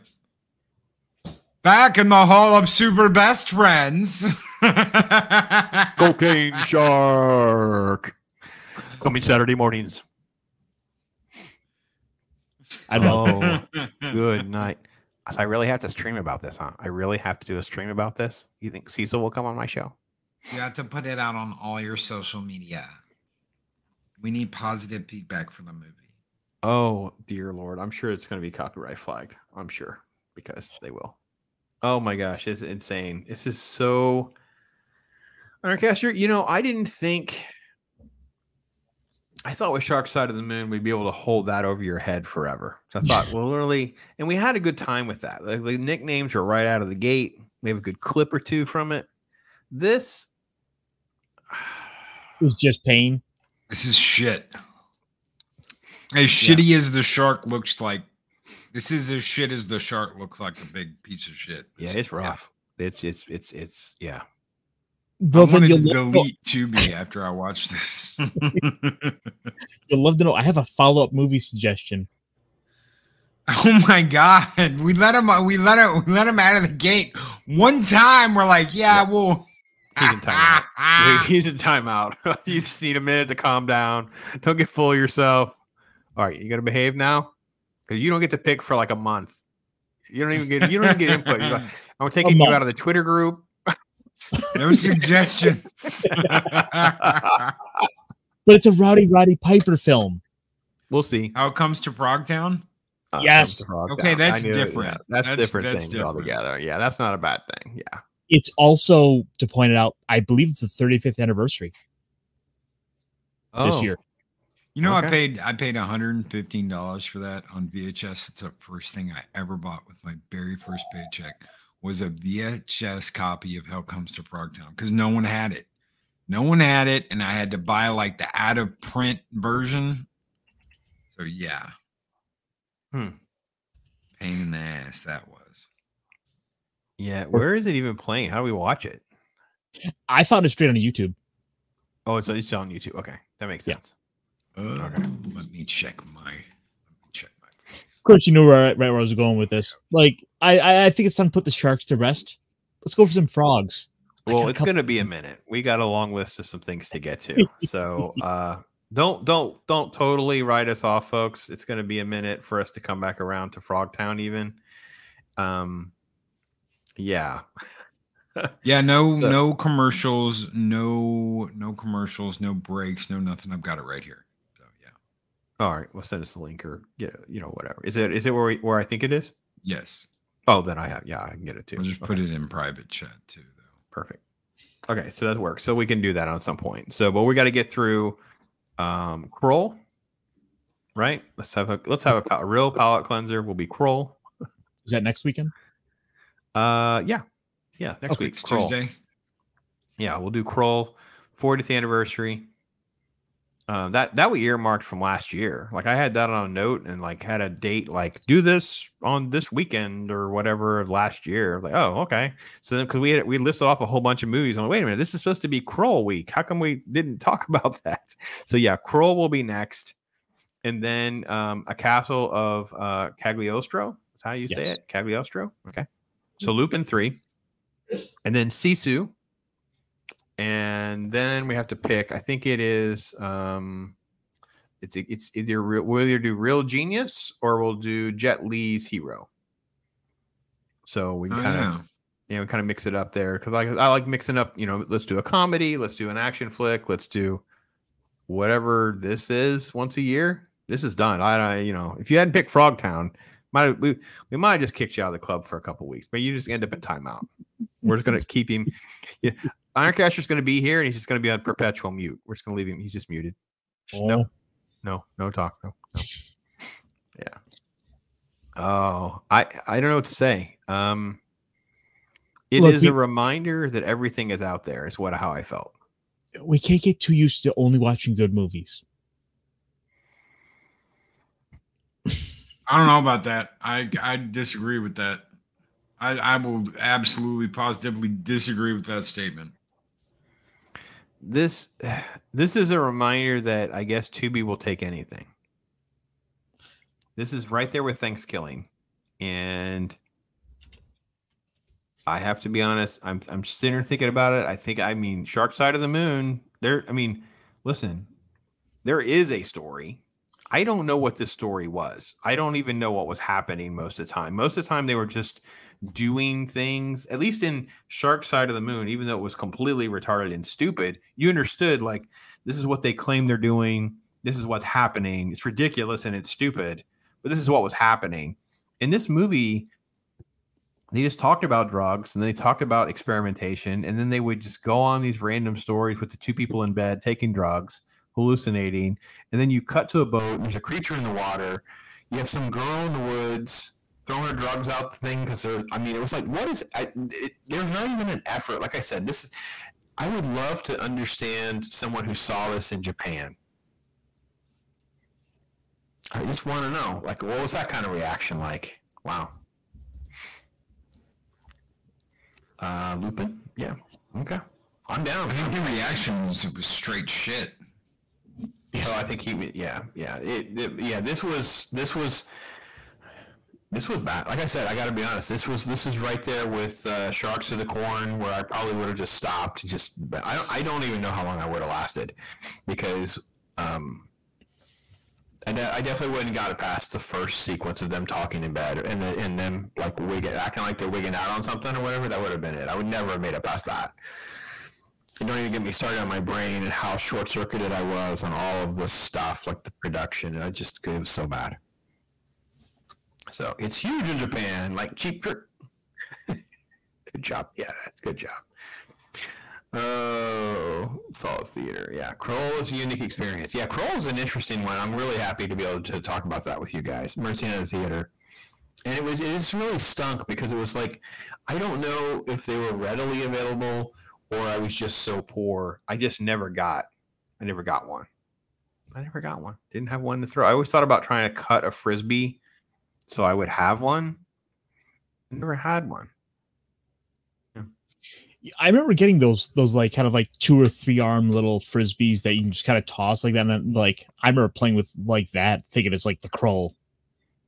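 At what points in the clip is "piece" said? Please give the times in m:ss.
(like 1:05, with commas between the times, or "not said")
1:01.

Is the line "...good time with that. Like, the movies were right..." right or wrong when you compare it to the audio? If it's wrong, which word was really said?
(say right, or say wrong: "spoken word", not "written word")
wrong: "nicknames", not "movies".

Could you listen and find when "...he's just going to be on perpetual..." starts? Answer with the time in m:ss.
4:20.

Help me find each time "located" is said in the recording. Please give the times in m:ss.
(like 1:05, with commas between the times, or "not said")
not said.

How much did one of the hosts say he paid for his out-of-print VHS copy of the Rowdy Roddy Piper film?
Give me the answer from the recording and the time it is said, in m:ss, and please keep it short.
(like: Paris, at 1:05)
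$115, at 1:55.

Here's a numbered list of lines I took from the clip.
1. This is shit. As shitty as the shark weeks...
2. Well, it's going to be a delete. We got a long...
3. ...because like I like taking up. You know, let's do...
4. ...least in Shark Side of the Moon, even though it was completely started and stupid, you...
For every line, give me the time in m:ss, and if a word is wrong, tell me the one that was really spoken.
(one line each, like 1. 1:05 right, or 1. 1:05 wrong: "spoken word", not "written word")
1. 0:53 wrong: "looks", not "weeks"
2. 2:34 wrong: "minute", not "delete"
3. 4:03 wrong: "mixing", not "taking"
4. 5:17 wrong: "retarded", not "started".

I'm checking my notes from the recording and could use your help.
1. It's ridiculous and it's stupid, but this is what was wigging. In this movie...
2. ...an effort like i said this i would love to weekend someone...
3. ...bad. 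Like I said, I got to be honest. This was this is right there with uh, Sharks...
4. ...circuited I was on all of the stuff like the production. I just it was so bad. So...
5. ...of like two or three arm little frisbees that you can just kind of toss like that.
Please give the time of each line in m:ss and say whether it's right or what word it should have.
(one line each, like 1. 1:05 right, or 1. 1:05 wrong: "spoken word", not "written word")
1. 5:25 wrong: "happening", not "wigging"
2. 5:48 wrong: "understand", not "weekend"
3. 6:13 right
4. 6:37 right
5. 7:20 right.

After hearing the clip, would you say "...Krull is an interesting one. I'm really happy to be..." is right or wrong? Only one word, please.
right.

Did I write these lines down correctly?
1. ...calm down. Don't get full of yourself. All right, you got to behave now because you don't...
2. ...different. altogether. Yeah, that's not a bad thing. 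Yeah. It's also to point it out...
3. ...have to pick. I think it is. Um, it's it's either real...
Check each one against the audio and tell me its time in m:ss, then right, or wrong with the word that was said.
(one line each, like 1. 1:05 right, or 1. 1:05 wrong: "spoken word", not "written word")
1. 1:23 right
2. 1:45 right
3. 3:51 right.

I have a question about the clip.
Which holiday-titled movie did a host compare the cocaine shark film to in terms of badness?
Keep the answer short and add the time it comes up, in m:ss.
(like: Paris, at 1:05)
Thanksgiving, at 4:57.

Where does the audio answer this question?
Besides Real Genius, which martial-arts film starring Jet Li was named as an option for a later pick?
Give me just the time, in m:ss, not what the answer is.
3:58.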